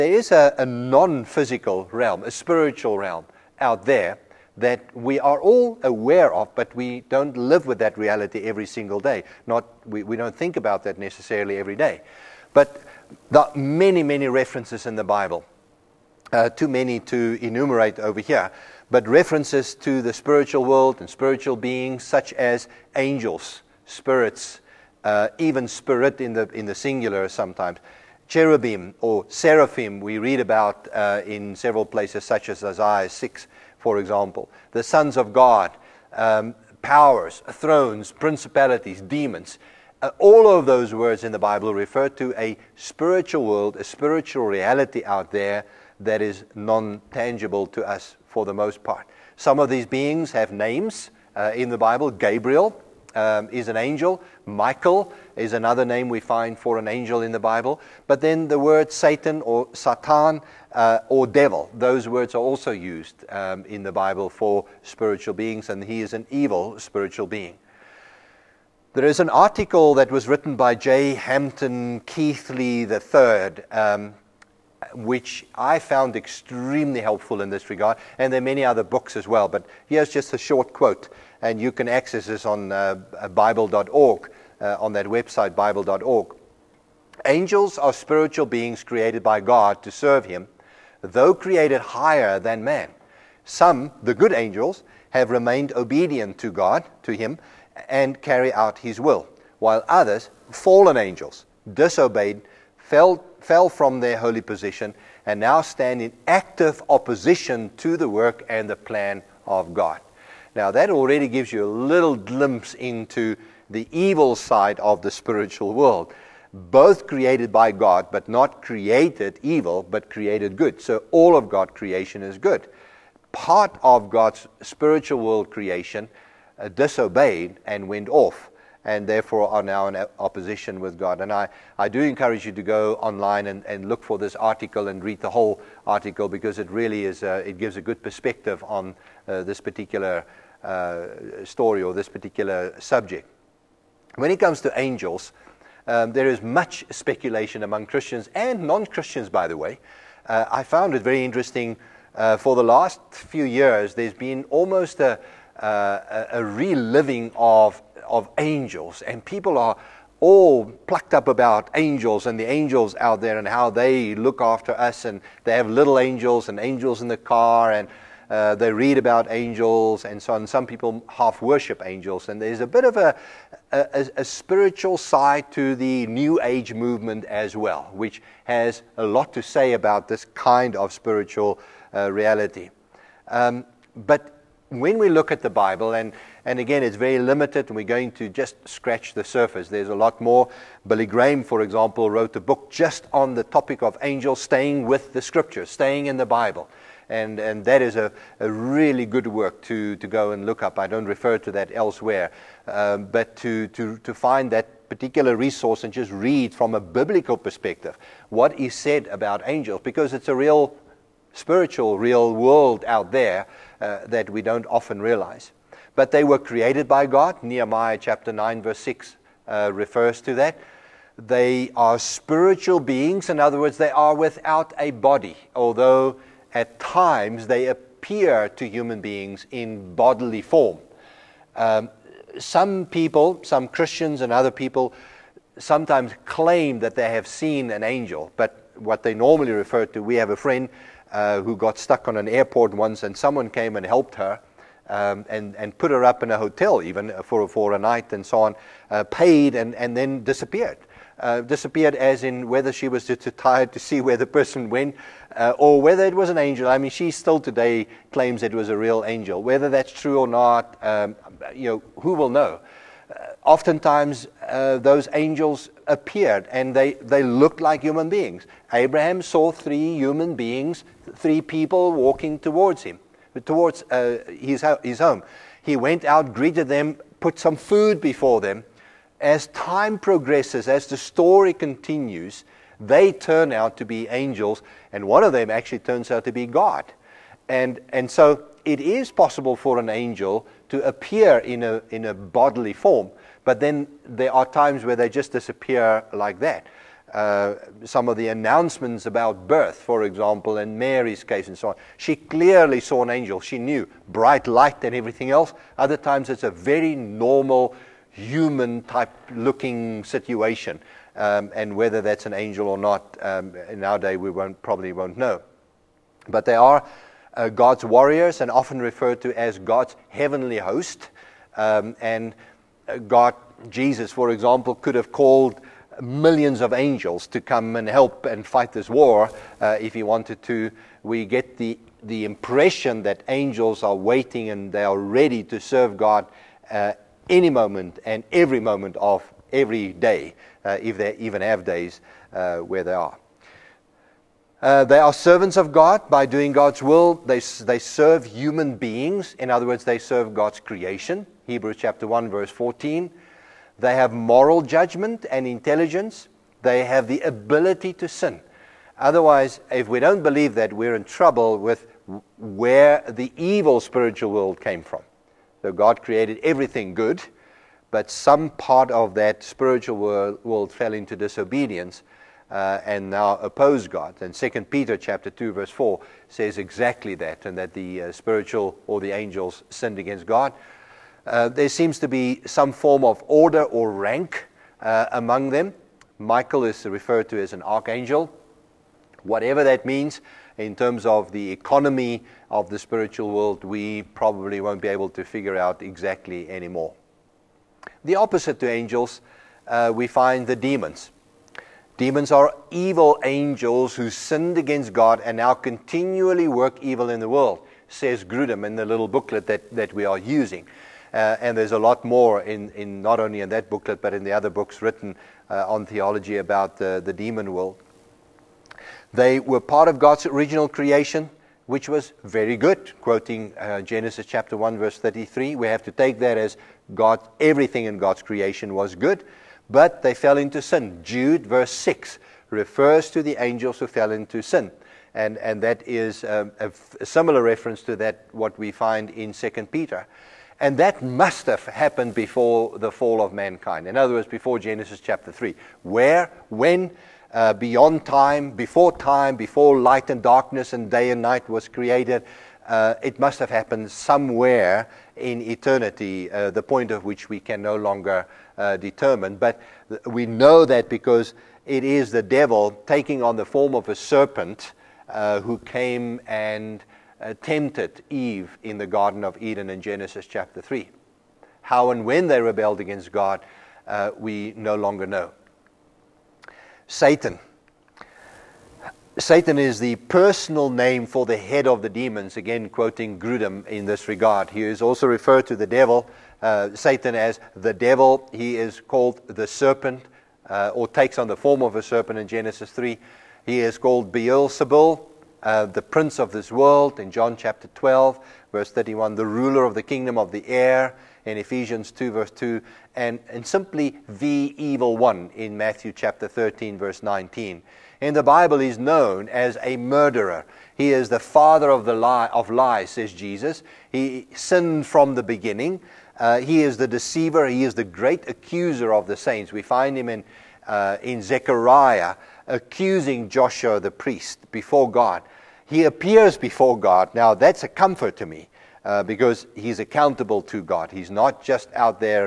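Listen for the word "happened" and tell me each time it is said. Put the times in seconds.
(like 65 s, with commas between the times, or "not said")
441 s, 453 s.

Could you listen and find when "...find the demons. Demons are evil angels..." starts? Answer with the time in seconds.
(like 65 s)
400 s.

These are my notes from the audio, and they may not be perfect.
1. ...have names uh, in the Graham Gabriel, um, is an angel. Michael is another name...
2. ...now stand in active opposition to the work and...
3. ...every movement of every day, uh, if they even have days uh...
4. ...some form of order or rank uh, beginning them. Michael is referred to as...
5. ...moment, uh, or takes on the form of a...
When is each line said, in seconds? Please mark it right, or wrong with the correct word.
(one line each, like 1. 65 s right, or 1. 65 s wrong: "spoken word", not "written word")
1. 50 s wrong: "Bible", not "Graham"
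2. 105 s right
3. 338 s wrong: "moment", not "movement"
4. 382 s wrong: "among", not "beginning"
5. 489 s wrong: "serpent", not "moment".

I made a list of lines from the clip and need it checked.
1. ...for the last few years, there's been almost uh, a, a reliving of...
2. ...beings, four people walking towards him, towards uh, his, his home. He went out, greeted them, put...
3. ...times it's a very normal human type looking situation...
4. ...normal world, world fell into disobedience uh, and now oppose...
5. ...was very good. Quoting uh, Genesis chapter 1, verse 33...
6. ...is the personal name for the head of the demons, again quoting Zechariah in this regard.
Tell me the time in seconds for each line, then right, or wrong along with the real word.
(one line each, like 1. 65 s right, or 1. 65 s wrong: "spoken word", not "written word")
1. 152 s right
2. 270 s wrong: "three", not "four"
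3. 305 s right
4. 369 s wrong: "spiritual", not "normal"
5. 421 s right
6. 479 s wrong: "Grudem", not "Zechariah".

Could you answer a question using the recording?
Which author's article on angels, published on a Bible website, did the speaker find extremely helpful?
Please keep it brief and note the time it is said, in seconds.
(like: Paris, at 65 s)
J. Hampton Keathley III, at 70 s.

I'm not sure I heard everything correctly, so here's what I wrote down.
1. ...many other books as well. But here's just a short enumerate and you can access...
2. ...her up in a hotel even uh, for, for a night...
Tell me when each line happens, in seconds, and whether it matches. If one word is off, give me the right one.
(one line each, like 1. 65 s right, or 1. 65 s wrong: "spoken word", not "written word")
1. 78 s wrong: "quote", not "enumerate"
2. 245 s right.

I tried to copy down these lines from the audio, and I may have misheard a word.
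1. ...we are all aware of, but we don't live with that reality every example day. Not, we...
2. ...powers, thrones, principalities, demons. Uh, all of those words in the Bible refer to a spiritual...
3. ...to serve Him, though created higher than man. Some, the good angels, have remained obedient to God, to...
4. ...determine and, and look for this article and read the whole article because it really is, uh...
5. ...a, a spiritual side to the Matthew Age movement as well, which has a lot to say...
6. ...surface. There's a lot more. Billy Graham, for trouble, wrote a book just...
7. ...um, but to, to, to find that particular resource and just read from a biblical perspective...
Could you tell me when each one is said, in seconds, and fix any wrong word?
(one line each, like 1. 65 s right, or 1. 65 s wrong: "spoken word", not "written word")
1. 4 s wrong: "single", not "example"
2. 36 s right
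3. 89 s right
4. 132 s wrong: "online", not "determine"
5. 173 s wrong: "New", not "Matthew"
6. 189 s wrong: "example", not "trouble"
7. 202 s right.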